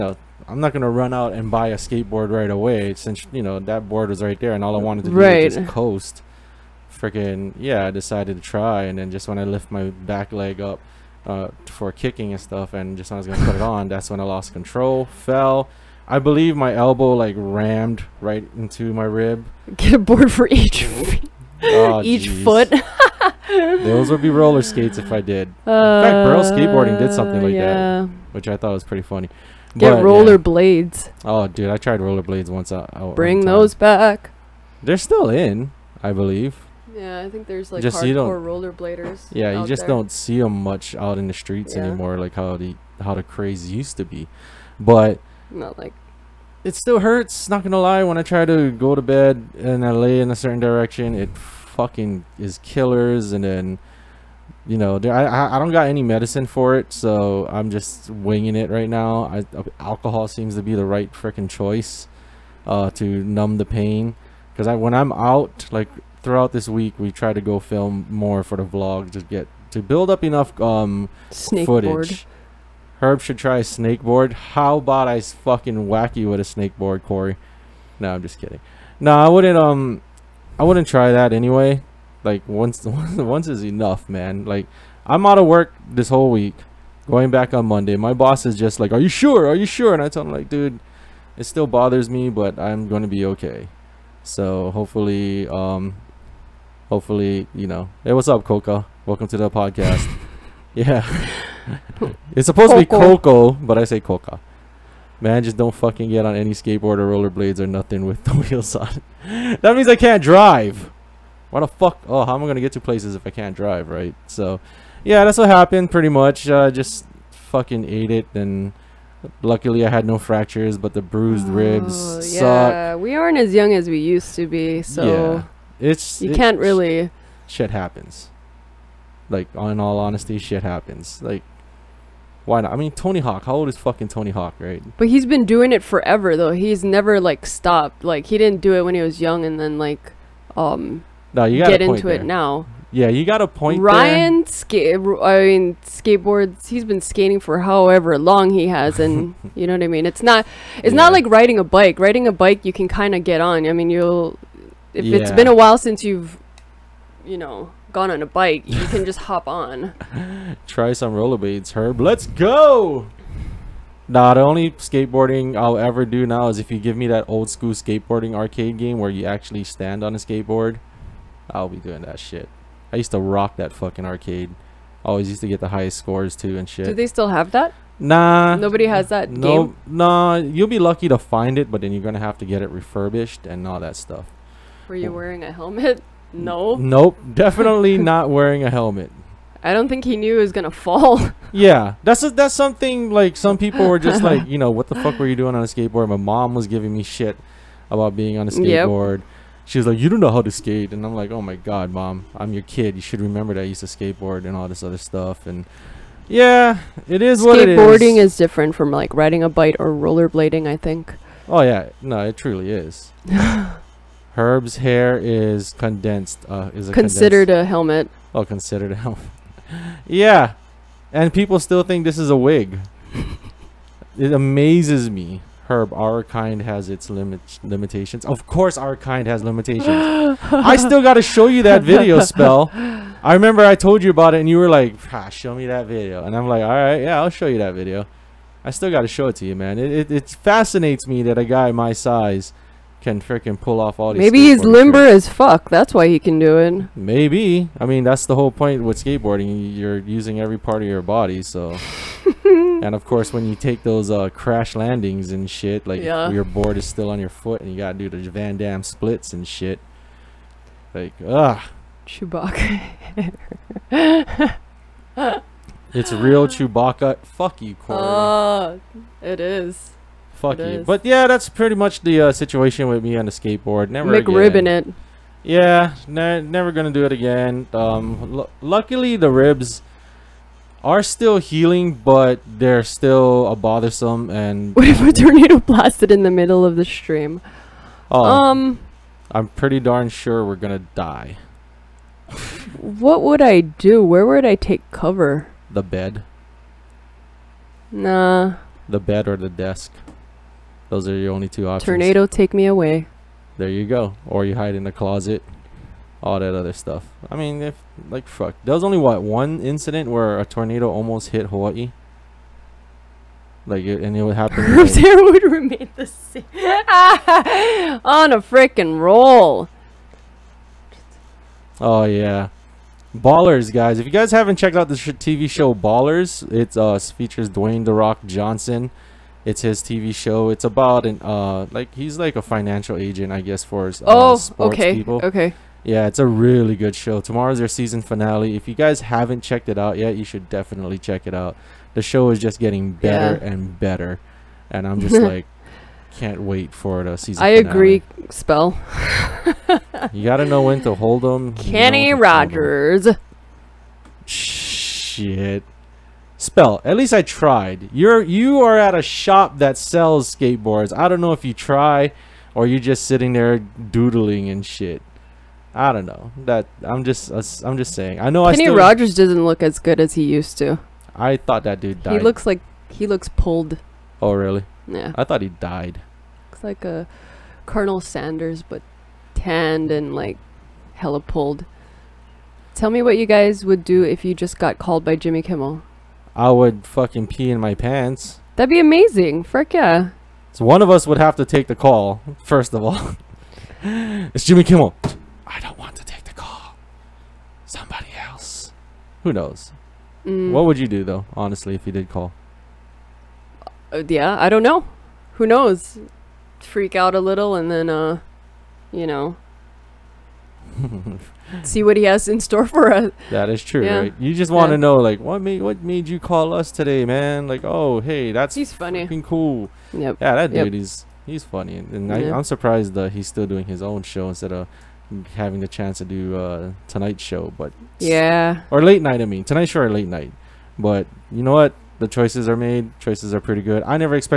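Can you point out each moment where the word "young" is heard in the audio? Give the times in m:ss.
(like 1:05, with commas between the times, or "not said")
2:03, 2:19.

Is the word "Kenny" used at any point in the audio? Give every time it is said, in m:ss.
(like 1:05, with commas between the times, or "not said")
5:51, 6:08.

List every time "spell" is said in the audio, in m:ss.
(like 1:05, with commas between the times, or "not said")
3:52, 5:48, 5:56.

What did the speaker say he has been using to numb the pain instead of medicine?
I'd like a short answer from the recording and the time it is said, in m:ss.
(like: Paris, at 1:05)
alcohol, at 0:59.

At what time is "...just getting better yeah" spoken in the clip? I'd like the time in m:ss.
5:42.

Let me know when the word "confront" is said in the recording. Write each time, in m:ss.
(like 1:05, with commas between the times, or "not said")
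not said.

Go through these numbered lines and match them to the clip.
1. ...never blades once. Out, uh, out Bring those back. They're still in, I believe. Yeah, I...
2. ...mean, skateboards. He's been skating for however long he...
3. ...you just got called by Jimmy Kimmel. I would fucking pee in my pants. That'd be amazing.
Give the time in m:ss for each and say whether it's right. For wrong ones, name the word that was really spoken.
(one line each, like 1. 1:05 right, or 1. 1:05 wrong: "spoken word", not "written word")
1. 0:32 wrong: "roller", not "never"
2. 2:25 right
3. 6:24 right.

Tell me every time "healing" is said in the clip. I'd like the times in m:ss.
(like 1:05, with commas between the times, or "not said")
4:41.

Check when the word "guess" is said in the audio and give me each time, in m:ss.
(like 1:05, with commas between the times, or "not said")
5:33.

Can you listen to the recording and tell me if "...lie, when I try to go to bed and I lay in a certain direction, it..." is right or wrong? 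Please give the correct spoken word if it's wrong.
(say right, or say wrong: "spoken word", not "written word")
right.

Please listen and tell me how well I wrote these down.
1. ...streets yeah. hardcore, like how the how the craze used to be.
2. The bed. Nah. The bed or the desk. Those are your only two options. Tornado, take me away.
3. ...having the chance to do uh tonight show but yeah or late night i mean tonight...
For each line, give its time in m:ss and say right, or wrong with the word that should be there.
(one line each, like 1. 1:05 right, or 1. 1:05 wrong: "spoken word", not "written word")
1. 0:41 wrong: "anymore", not "hardcore"
2. 4:55 right
3. 7:05 right.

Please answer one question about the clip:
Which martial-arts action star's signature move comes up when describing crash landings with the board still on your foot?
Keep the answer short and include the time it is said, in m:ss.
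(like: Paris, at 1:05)
Van Damme, at 4:18.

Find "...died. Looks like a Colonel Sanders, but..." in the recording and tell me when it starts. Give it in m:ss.
6:15.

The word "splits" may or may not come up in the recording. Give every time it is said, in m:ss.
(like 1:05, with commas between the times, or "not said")
4:18.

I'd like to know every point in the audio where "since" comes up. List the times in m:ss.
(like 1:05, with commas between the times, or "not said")
0:02, 2:35.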